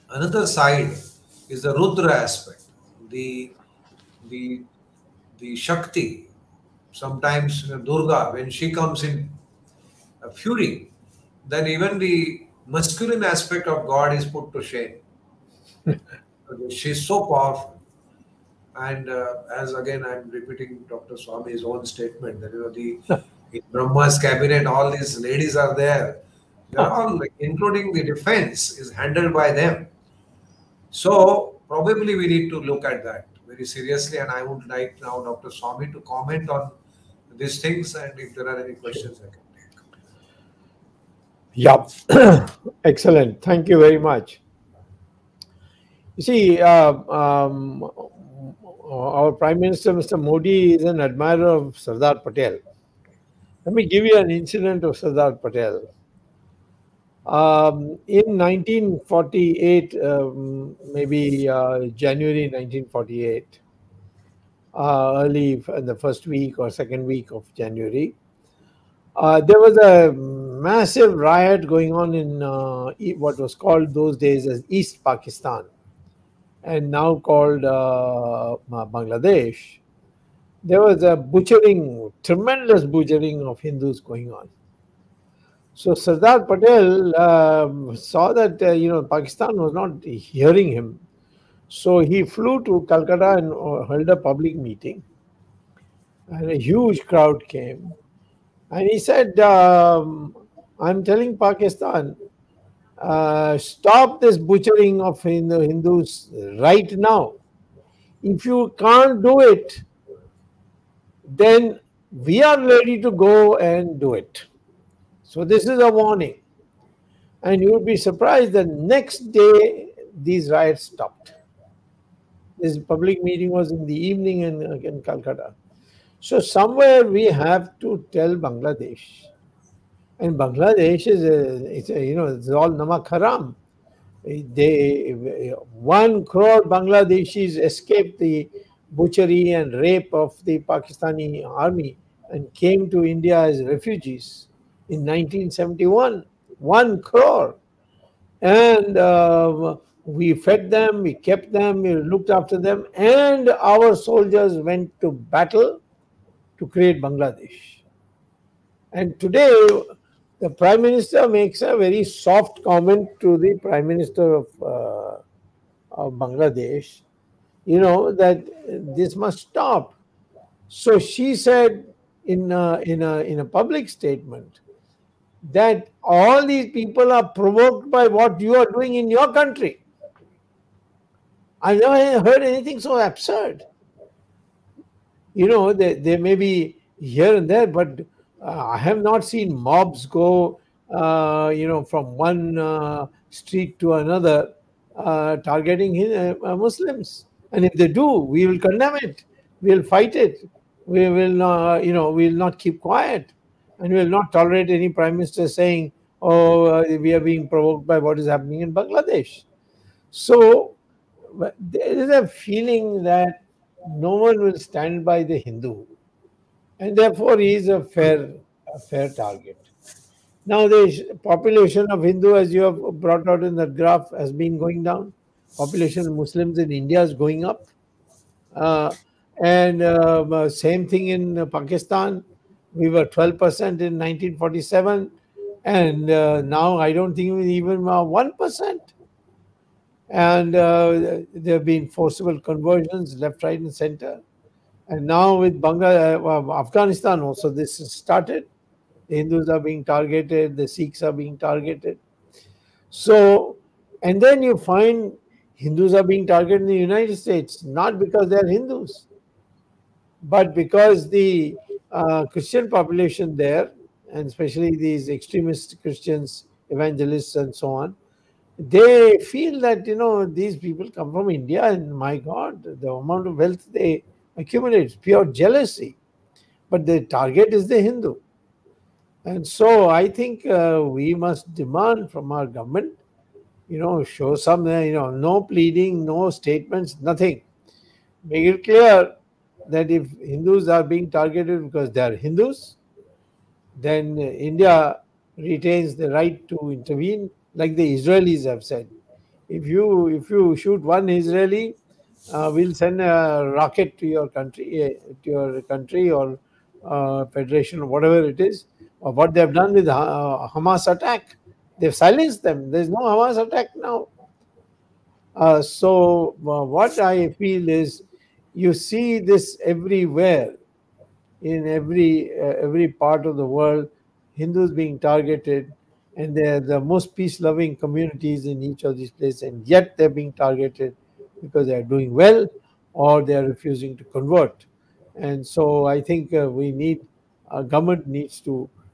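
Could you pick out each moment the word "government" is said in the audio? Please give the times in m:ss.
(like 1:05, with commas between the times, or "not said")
4:42, 5:37.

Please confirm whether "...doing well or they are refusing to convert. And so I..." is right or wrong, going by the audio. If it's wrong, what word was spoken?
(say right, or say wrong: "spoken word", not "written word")
right.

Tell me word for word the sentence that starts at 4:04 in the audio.
And now with Bangla, uh, Afghanistan also, this has started.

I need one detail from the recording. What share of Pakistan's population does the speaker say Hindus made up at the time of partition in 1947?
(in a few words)
12%.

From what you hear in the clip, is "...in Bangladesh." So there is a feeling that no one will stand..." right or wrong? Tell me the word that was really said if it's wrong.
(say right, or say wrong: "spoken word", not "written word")
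right.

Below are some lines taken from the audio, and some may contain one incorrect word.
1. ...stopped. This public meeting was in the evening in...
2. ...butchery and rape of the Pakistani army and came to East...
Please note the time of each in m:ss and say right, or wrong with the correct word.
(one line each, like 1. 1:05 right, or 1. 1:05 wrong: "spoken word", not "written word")
1. 2:00 right
2. 2:18 wrong: "India", not "East".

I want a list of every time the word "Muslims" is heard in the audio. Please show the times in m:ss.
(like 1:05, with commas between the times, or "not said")
3:16, 3:46.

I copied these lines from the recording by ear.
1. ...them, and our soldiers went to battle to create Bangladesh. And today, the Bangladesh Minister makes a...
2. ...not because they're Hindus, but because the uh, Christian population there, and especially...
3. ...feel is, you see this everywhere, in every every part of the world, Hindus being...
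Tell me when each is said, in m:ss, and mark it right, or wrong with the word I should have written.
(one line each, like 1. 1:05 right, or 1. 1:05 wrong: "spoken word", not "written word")
1. 2:32 wrong: "Prime", not "Bangladesh"
2. 4:17 right
3. 5:17 right.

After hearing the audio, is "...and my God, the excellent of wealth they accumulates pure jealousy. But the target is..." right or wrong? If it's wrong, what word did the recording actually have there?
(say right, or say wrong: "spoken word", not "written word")
wrong: "amount", not "excellent".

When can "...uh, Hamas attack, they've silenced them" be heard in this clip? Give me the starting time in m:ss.
5:10.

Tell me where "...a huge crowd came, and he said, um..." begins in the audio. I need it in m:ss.
1:36.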